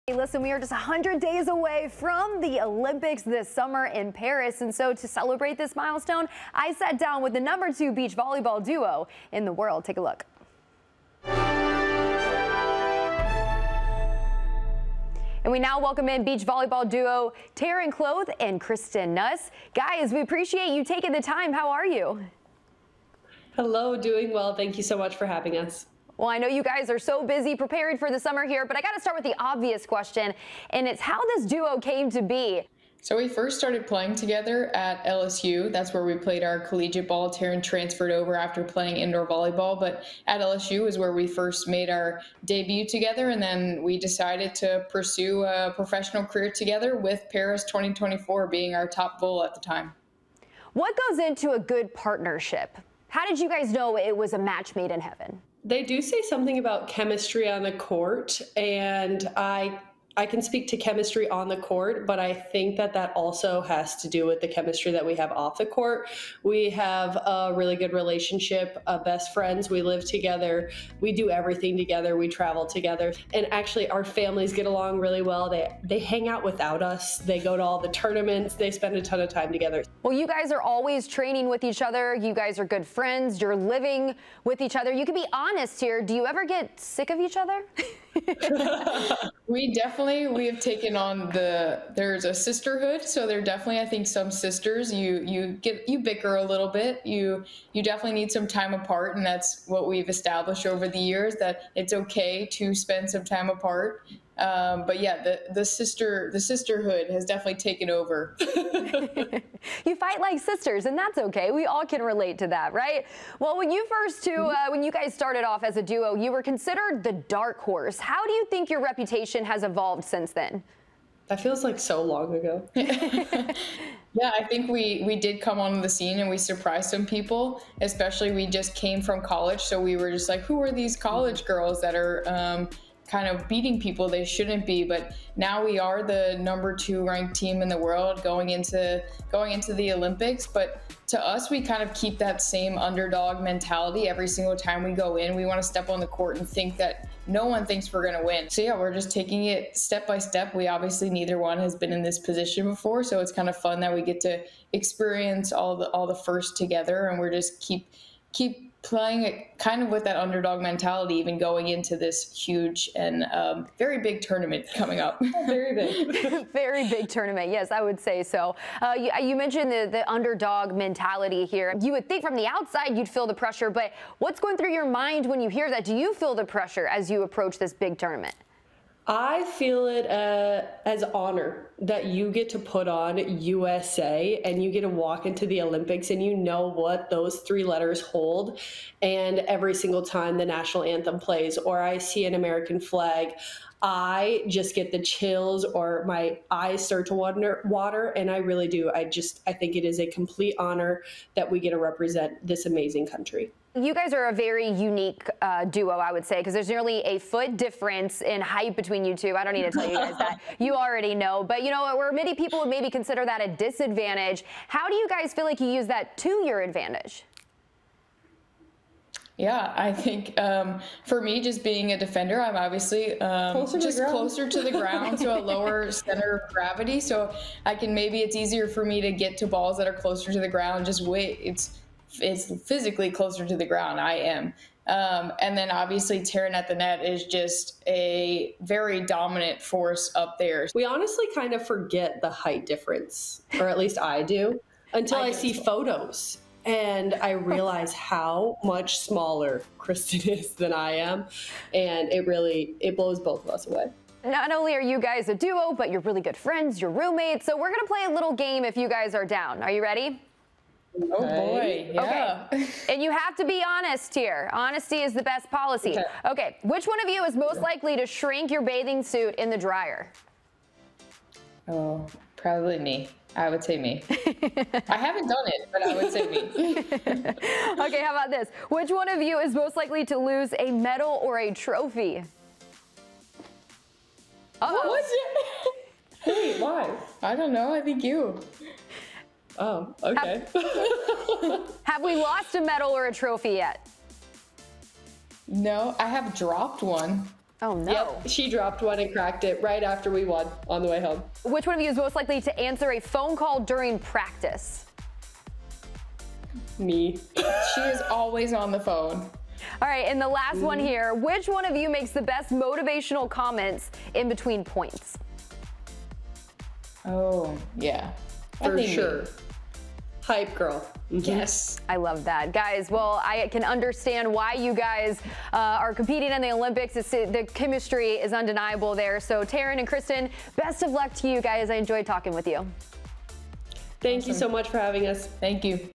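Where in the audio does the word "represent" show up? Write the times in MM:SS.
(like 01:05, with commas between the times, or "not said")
03:21.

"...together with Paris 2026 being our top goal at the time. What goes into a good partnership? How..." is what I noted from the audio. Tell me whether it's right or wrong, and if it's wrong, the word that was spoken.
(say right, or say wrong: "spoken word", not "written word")
wrong: "2024", not "2026".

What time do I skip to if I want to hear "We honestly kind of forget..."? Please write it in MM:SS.
04:00.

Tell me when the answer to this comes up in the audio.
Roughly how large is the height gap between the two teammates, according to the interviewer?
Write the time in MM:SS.
03:26.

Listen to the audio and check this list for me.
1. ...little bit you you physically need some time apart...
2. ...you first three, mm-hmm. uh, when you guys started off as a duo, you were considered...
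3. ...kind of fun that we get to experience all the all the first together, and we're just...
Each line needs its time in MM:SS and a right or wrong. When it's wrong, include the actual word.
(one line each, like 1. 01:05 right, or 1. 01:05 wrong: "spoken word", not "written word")
1. 01:36 wrong: "definitely", not "physically"
2. 01:53 wrong: "two", not "three"
3. 02:33 right.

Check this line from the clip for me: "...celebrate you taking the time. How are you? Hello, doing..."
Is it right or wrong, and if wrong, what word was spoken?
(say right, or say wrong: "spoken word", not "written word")
wrong: "appreciate", not "celebrate".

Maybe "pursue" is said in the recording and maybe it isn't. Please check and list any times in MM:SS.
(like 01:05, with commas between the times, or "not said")
00:44.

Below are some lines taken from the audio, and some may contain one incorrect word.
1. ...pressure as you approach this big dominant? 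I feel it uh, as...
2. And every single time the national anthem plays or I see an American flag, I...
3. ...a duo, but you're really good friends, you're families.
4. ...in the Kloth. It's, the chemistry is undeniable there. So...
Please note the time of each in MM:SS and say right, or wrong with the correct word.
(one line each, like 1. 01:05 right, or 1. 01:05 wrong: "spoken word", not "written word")
1. 02:56 wrong: "tournament", not "dominant"
2. 03:09 right
3. 04:15 wrong: "roommates", not "families"
4. 05:26 wrong: "Olympics", not "Kloth".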